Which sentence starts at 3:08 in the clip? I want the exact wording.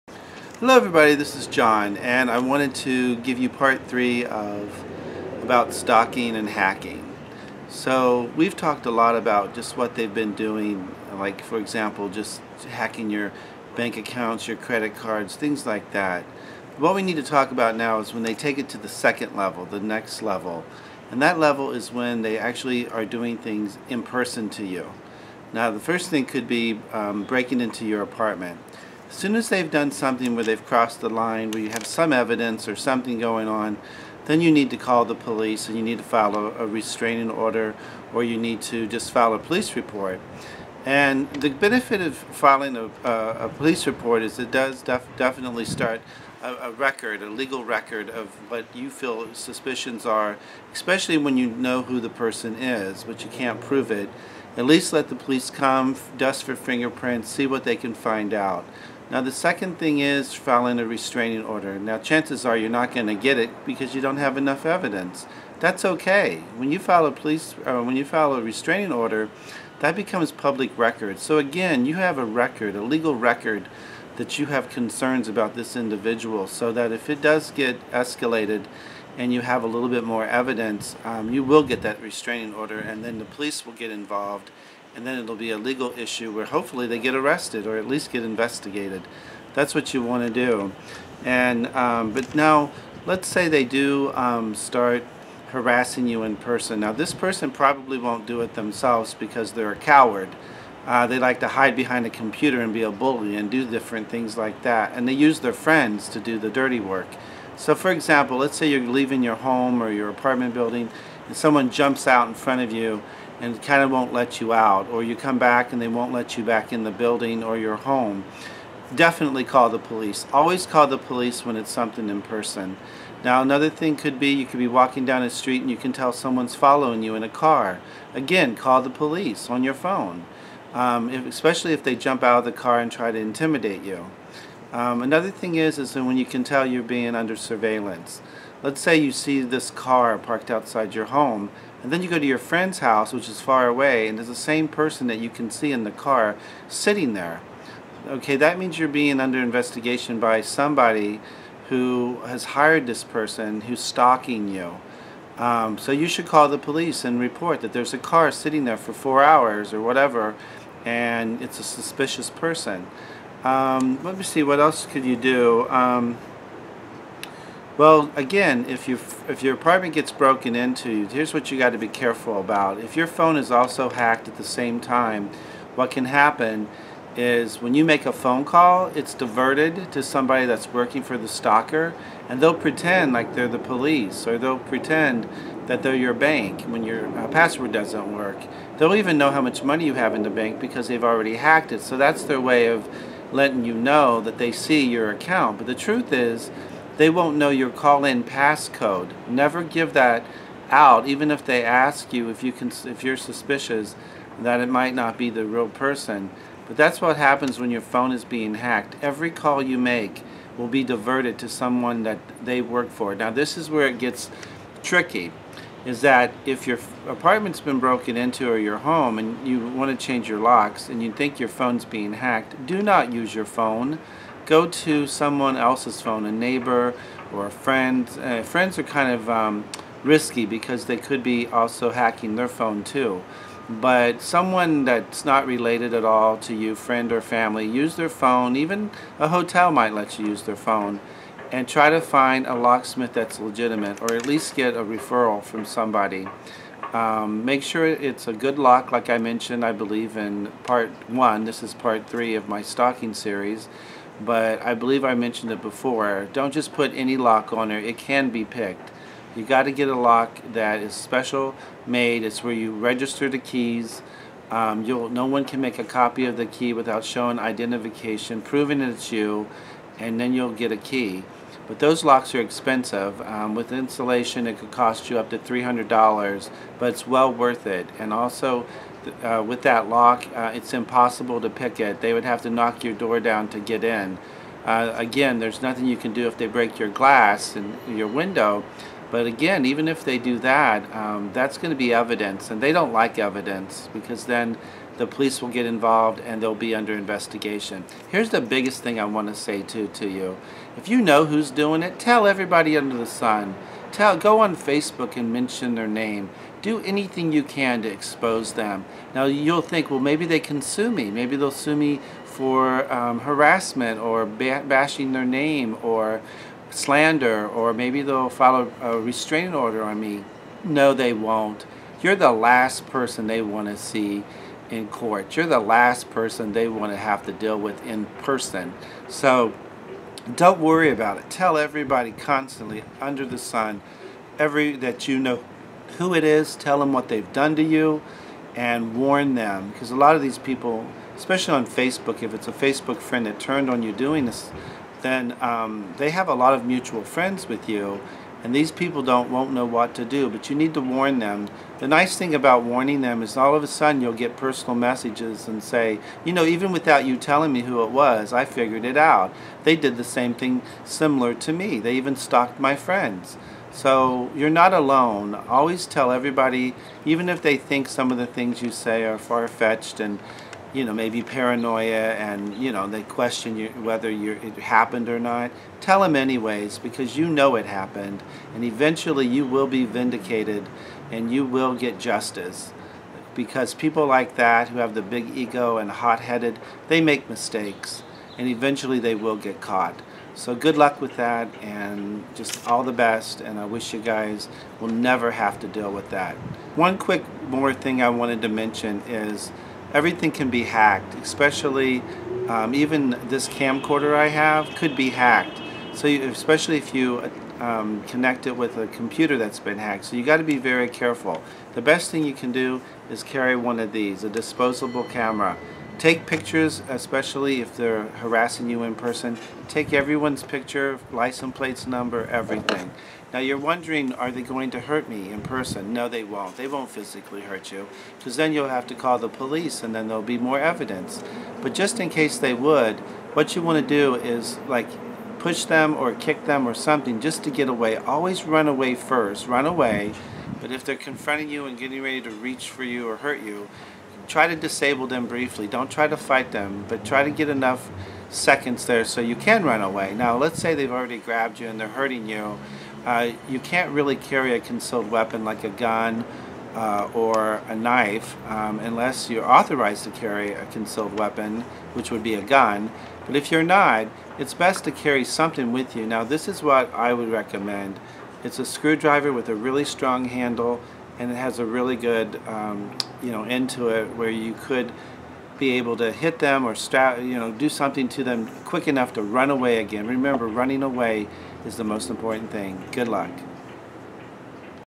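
They'll even know how much money you have in the bank because they've already hacked it.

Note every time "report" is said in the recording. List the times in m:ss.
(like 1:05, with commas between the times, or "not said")
0:39, 0:43, 2:37.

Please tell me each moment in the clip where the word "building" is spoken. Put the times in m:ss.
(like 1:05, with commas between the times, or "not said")
1:50, 1:56.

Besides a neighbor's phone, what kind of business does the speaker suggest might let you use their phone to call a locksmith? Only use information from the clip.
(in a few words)
a hotel.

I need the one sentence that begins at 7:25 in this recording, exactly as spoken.
Don't try to fight them, but try to get enough seconds there so you can run away.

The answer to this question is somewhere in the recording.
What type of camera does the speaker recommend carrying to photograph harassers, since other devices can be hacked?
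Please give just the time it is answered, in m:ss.
6:54.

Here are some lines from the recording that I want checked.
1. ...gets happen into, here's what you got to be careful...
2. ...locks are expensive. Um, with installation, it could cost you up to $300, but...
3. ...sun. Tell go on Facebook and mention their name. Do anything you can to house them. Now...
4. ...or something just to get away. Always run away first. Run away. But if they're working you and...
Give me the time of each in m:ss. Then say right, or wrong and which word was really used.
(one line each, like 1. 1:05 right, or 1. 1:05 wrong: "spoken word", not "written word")
1. 2:49 wrong: "broken", not "happen"
2. 4:32 right
3. 5:03 wrong: "expose", not "house"
4. 7:16 wrong: "confronting", not "working".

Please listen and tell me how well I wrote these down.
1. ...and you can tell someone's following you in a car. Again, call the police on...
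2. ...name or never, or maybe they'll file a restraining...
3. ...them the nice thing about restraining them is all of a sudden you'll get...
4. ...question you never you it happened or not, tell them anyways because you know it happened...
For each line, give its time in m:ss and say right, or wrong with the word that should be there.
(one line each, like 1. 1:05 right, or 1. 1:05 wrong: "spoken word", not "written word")
1. 2:05 right
2. 5:15 wrong: "slander", not "never"
3. 5:51 wrong: "warning", not "restraining"
4. 6:13 wrong: "whether", not "never".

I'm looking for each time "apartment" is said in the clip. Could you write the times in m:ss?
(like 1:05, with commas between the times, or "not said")
0:28, 1:50, 2:49, 3:37.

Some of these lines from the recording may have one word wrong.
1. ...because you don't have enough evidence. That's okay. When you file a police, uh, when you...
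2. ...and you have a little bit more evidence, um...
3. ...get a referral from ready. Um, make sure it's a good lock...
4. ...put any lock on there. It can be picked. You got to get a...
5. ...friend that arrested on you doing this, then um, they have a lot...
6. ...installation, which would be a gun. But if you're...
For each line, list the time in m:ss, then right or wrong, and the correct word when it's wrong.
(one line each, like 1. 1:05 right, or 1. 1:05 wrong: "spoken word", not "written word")
1. 1:03 right
2. 1:19 right
3. 4:04 wrong: "somebody", not "ready"
4. 4:16 right
5. 5:43 wrong: "turned", not "arrested"
6. 7:41 wrong: "weapon", not "installation".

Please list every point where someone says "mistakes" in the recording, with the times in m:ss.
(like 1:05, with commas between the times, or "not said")
6:27.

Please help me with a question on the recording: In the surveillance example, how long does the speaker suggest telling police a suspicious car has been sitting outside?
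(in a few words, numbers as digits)
four hours.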